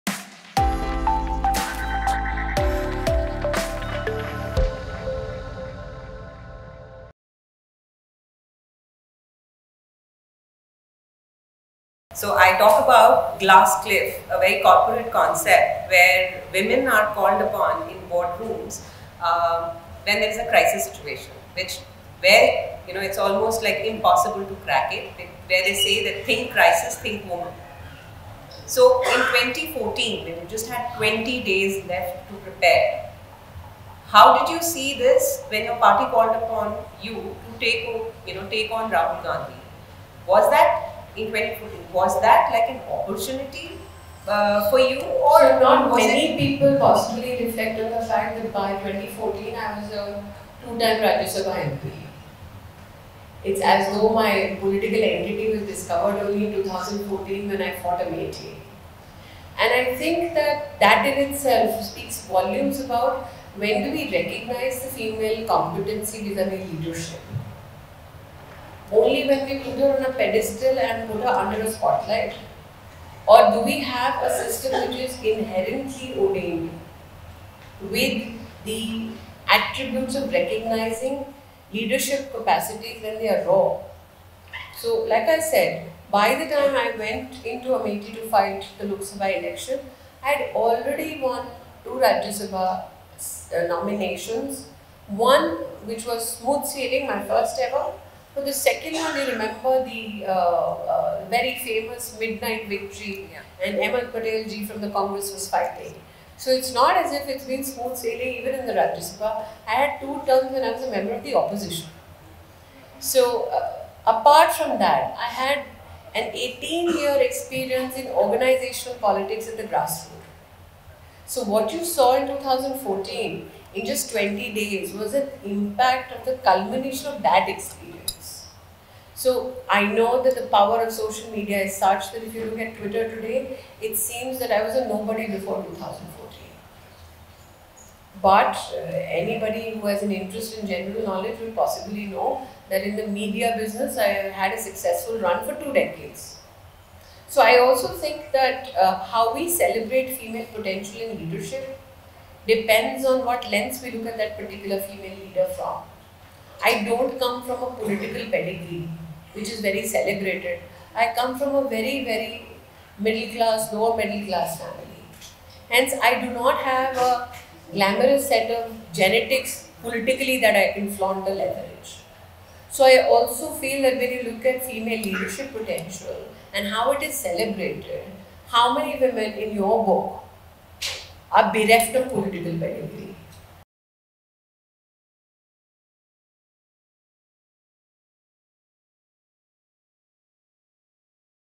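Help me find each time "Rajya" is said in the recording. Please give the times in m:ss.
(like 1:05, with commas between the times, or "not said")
0:51, 1:31, 1:48.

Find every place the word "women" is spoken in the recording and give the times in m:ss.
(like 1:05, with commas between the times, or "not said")
0:16, 2:58.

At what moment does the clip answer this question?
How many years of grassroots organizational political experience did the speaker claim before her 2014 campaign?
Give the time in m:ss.
1:56.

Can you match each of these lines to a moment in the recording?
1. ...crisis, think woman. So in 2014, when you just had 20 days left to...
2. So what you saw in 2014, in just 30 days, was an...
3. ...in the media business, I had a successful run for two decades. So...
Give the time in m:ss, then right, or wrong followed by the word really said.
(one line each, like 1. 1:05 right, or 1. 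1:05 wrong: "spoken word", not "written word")
1. 0:26 right
2. 2:01 wrong: "20", not "30"
3. 2:22 right.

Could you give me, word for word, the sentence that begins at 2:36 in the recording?
I don't come from a political pedigree which is very celebrated.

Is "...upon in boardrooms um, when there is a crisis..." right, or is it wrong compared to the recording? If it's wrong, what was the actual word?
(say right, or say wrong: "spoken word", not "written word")
right.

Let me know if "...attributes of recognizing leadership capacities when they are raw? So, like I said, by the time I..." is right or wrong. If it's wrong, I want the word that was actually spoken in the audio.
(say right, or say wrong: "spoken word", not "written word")
right.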